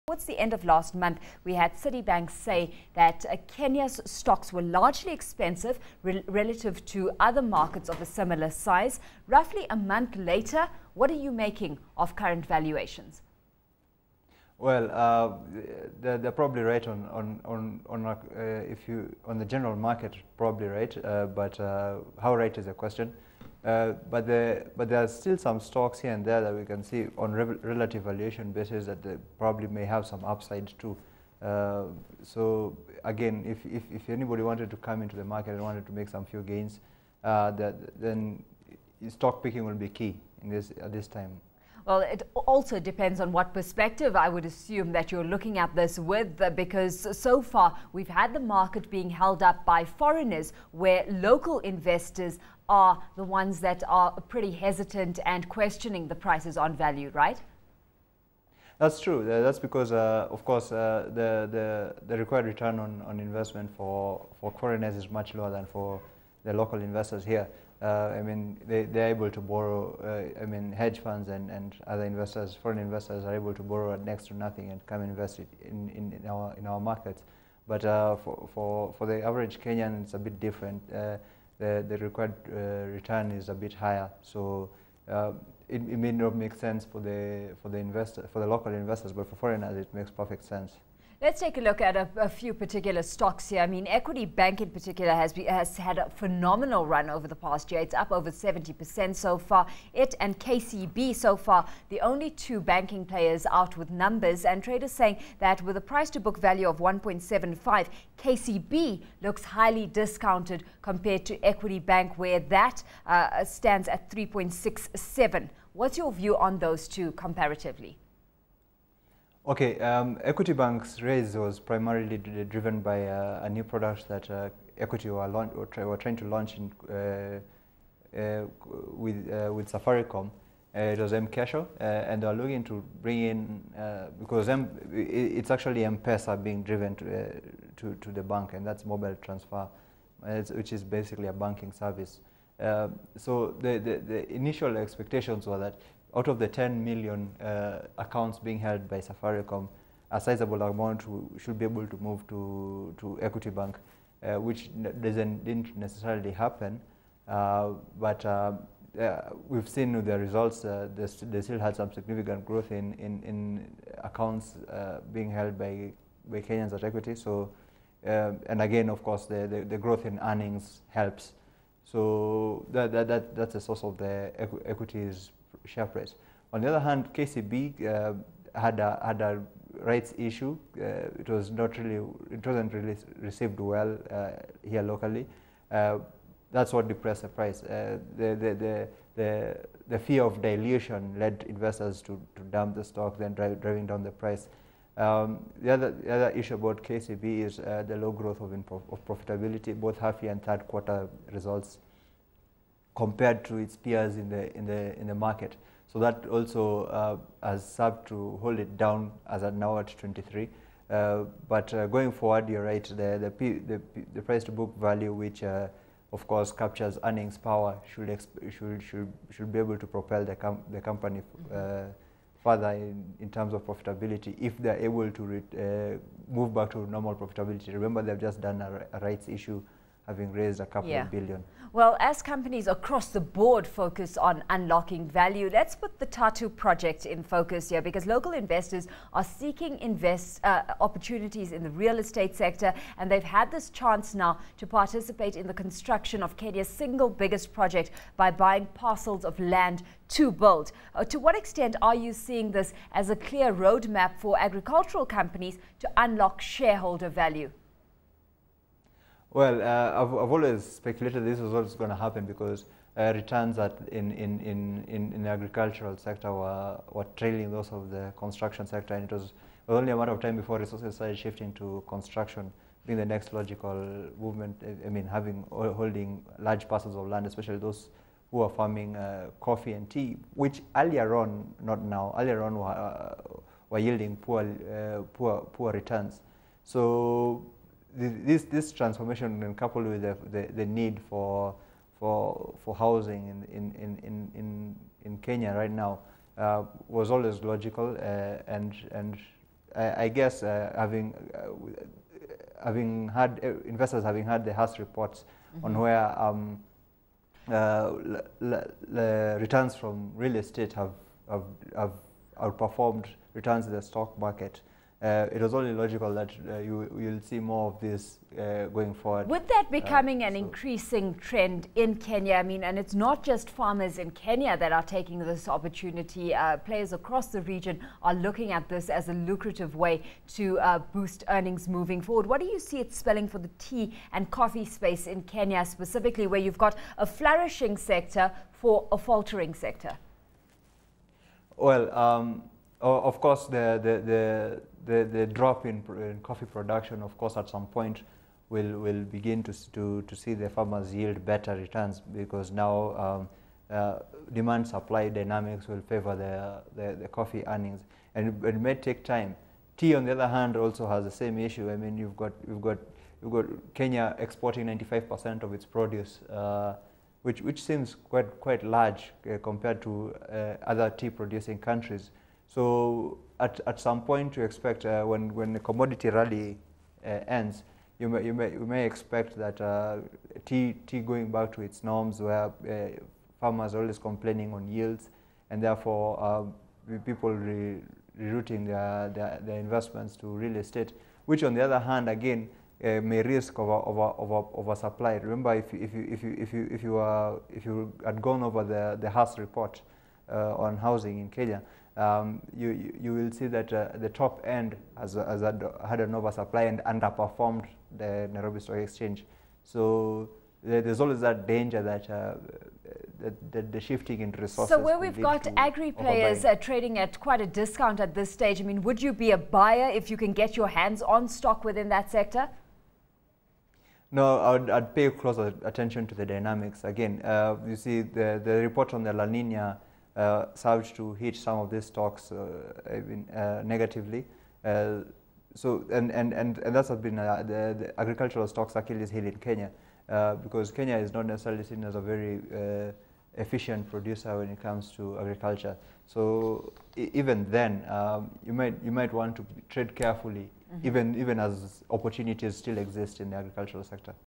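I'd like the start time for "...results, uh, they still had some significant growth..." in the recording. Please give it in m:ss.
2:40.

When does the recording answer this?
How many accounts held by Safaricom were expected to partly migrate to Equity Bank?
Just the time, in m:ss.
2:26.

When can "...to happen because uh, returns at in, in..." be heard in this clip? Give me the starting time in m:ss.
4:21.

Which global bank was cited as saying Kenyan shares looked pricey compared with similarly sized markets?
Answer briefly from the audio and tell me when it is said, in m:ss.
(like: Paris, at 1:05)
Citibank, at 0:01.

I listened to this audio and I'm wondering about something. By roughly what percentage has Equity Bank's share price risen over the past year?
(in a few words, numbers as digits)
70%.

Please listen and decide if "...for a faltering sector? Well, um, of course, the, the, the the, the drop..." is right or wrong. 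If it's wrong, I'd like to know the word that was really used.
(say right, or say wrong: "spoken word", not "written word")
right.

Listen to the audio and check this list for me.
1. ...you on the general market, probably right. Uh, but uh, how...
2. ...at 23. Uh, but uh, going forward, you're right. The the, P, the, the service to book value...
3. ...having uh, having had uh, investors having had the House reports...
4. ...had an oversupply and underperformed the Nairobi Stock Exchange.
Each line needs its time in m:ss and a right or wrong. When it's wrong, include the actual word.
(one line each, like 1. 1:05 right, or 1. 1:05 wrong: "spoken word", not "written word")
1. 0:18 right
2. 3:29 wrong: "price", not "service"
3. 5:00 right
4. 6:45 right.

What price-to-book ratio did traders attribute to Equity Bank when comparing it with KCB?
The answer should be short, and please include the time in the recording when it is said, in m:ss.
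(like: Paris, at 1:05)
3.67, at 1:54.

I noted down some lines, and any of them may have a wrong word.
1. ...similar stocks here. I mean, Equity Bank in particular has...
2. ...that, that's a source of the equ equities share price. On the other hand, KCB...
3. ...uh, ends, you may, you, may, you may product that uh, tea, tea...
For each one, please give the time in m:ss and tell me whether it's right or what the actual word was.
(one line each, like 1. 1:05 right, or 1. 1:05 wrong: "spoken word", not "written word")
1. 1:32 wrong: "particular", not "similar"
2. 2:53 right
3. 6:17 wrong: "expect", not "product".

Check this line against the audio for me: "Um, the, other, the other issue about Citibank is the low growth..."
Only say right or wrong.
wrong.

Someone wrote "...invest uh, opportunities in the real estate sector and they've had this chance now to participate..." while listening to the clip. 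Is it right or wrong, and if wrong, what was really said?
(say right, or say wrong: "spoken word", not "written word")
right.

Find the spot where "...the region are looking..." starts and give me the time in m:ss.
5:27.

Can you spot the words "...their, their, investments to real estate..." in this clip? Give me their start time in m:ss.
6:29.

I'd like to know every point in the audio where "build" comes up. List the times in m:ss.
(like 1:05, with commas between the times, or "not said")
4:10.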